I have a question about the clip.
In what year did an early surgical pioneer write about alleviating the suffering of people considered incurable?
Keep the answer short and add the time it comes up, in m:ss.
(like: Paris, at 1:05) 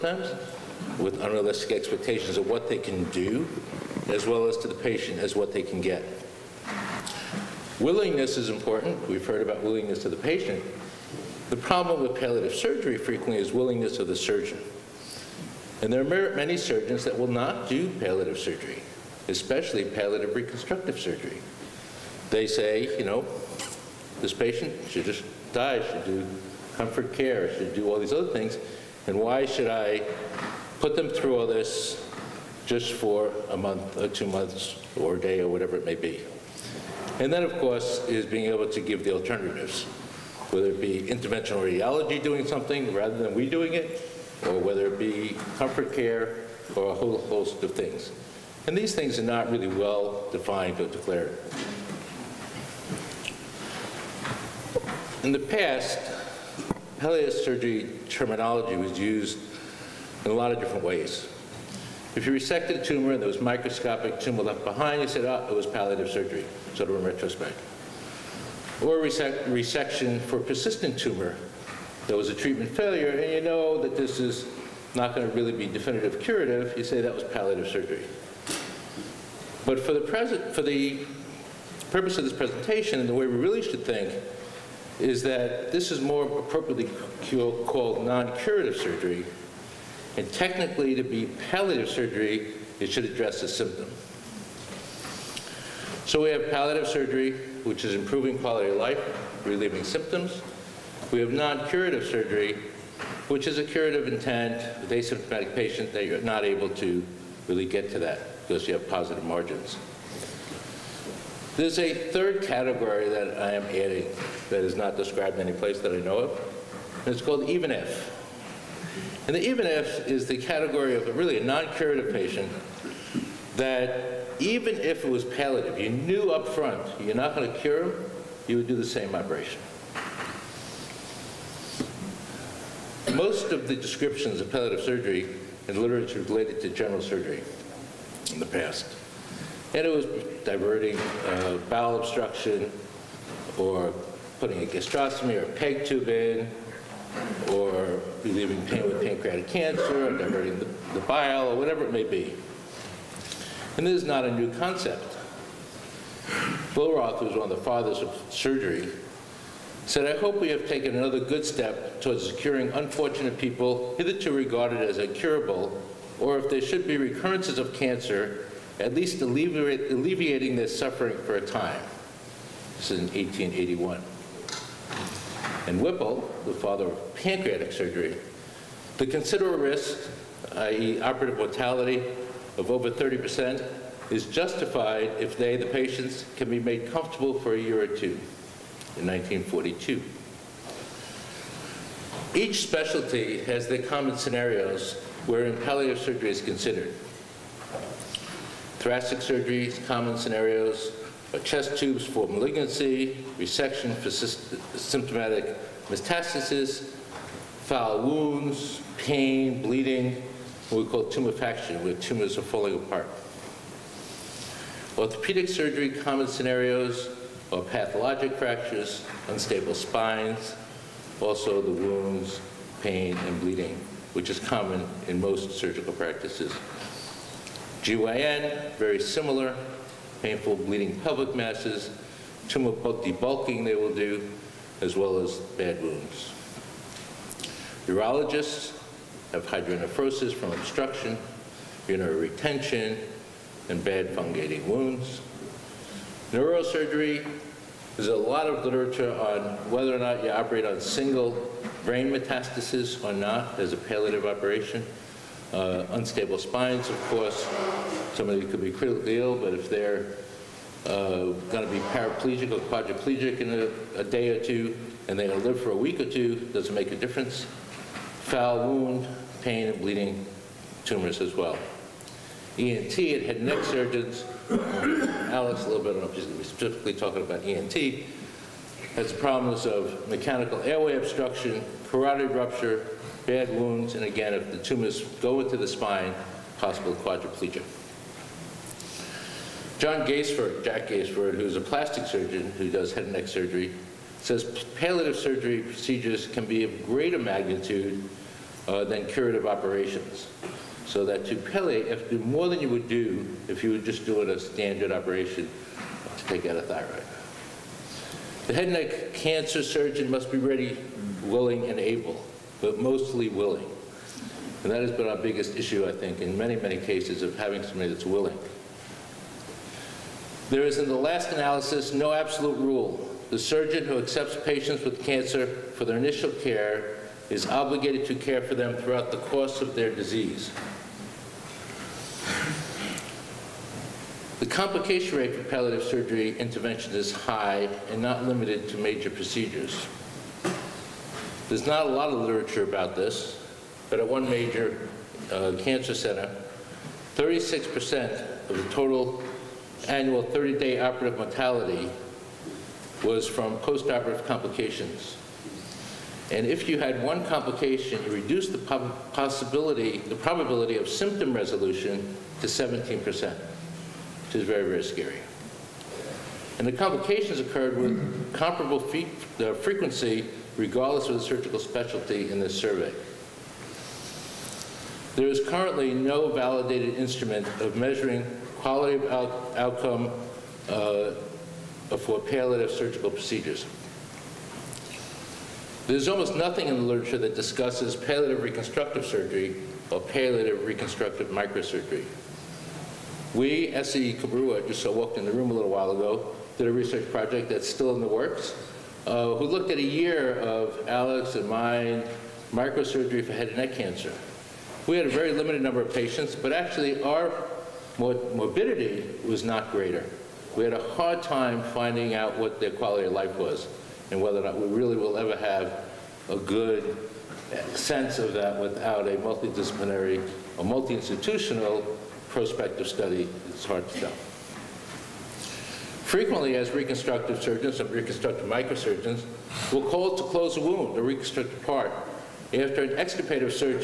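1881, at 2:53.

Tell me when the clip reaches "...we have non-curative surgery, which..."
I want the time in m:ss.
1:41.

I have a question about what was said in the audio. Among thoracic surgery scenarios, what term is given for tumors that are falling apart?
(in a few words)
tumefaction.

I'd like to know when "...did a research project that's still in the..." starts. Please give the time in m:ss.
6:36.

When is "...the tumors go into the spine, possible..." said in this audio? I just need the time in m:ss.
4:44.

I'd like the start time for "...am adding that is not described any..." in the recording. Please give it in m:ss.
1:53.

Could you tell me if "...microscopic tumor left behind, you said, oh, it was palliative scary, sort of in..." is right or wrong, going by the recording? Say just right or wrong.
wrong.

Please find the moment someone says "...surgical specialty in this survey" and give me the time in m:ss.
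6:11.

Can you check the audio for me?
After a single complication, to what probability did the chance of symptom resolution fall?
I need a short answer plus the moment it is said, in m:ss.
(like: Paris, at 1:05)
17 percent, at 6:02.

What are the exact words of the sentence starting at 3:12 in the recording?
Each specialty has their common scenarios wherein palliative surgery is considered.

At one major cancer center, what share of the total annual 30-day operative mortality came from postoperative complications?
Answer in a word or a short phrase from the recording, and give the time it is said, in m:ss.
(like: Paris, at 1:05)
36%, at 5:47.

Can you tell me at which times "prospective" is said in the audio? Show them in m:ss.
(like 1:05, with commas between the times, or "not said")
7:02.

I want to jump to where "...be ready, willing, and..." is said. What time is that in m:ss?
5:10.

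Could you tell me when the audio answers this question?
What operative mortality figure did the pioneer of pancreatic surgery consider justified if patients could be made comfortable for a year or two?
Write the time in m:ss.
3:02.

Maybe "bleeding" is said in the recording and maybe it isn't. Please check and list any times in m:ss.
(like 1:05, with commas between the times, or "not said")
3:29, 3:43, 3:50, 4:29.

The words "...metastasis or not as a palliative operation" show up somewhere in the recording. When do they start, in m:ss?
4:12.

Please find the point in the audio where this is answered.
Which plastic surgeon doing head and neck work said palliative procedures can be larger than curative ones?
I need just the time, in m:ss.
4:50.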